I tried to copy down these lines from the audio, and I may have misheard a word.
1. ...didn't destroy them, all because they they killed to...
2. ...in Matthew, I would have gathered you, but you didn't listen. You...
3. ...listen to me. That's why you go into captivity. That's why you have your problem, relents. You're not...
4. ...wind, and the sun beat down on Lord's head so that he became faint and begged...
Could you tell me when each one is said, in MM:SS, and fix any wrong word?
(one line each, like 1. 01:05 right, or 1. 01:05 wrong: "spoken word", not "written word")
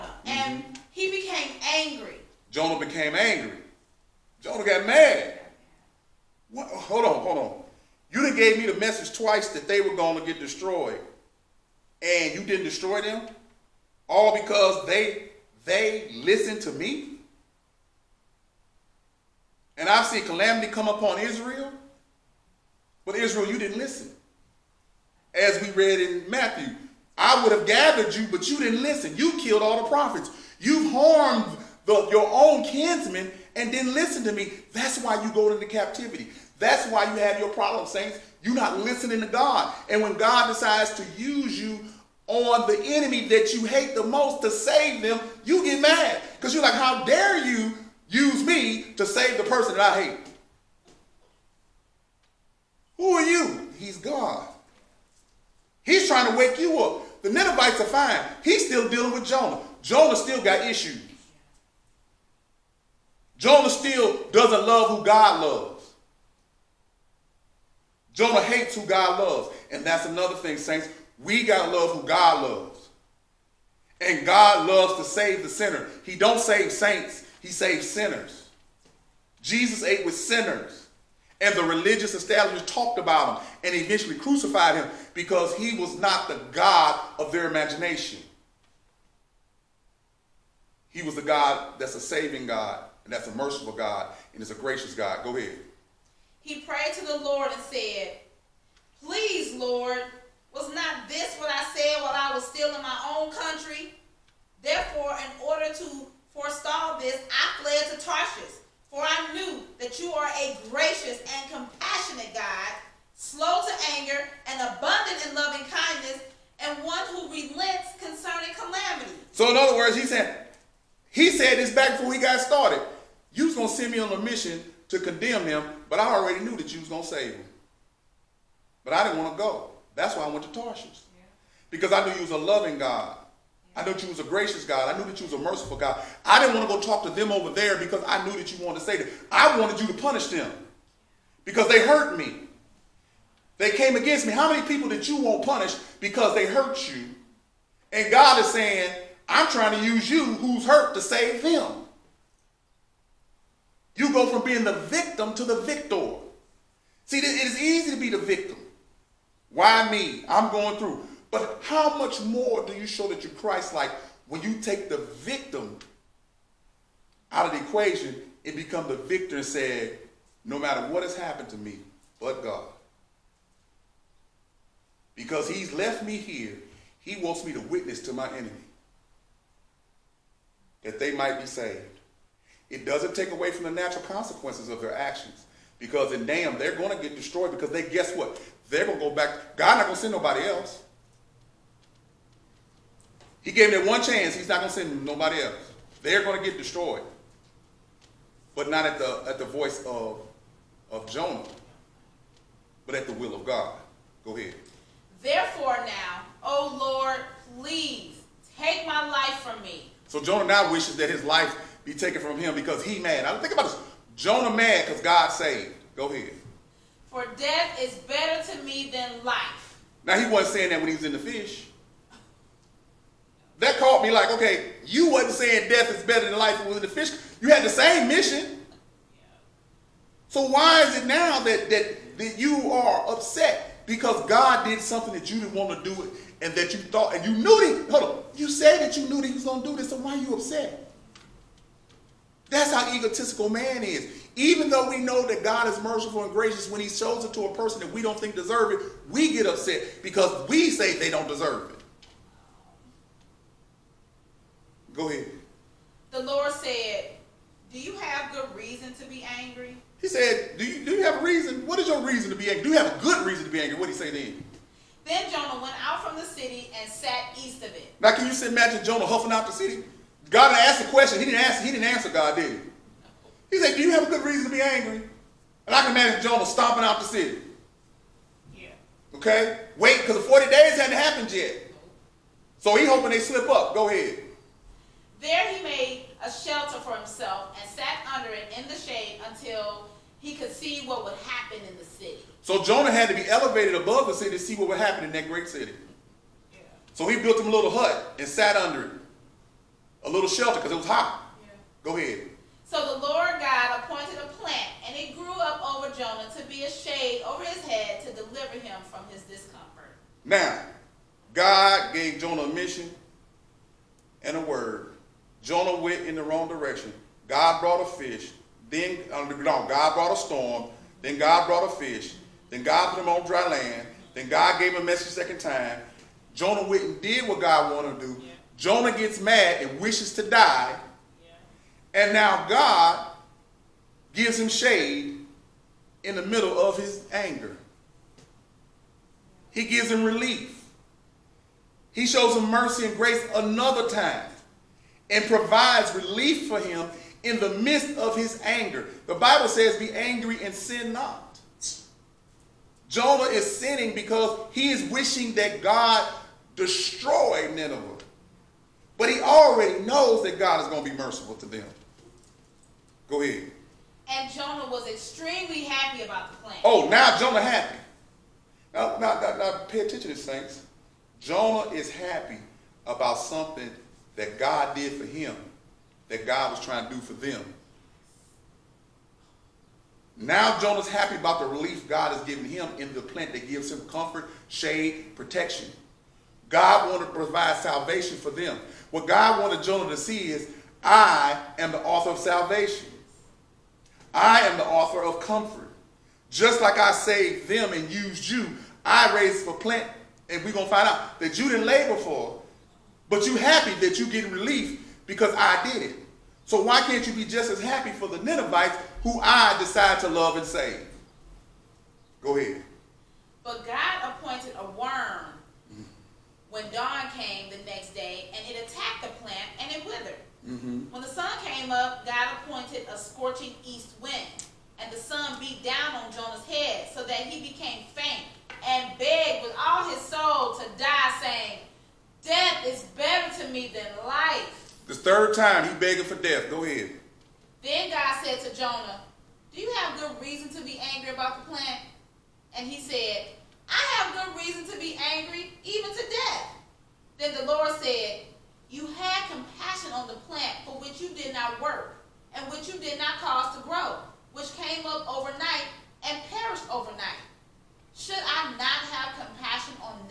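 1. 00:12 wrong: "listened", not "killed"
2. 00:25 right
3. 00:33 wrong: "saints", not "relents"
4. 07:04 wrong: "Jonah", not "Lord".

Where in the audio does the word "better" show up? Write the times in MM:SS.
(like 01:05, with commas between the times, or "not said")
03:37, 03:46, 07:13.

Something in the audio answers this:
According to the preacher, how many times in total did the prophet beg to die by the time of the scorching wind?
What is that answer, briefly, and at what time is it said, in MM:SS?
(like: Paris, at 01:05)
3, at 07:14.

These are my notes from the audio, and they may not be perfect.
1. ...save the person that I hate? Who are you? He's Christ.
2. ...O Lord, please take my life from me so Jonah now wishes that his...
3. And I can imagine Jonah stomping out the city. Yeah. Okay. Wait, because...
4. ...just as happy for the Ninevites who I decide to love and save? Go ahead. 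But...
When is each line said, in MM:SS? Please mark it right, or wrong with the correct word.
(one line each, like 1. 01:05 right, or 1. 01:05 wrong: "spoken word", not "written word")
1. 00:49 wrong: "God", not "Christ"
2. 03:26 right
3. 04:35 right
4. 06:47 right.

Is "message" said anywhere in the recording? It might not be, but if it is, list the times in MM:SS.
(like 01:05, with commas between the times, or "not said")
00:08, 05:24.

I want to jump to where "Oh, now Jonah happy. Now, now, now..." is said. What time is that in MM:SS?
06:06.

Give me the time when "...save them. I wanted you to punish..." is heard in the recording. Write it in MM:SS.
02:18.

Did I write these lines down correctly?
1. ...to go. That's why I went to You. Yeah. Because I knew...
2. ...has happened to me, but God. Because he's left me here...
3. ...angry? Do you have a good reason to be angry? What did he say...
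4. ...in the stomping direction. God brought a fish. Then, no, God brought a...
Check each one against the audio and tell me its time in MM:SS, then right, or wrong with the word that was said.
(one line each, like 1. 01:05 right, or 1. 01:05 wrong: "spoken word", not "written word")
1. 02:09 wrong: "Tarshish", not "You"
2. 02:51 right
3. 04:22 right
4. 05:16 wrong: "wrong", not "stomping".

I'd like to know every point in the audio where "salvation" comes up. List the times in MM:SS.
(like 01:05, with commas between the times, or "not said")
06:27, 06:32.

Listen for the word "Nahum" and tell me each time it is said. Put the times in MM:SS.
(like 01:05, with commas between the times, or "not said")
03:06.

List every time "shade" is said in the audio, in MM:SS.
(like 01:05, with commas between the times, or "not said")
04:48, 05:06, 05:34, 06:24.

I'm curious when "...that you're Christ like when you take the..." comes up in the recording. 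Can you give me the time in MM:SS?
02:43.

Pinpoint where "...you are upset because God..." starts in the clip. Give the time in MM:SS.
03:52.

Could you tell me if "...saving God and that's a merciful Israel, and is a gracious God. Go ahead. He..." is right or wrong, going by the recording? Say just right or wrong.
wrong.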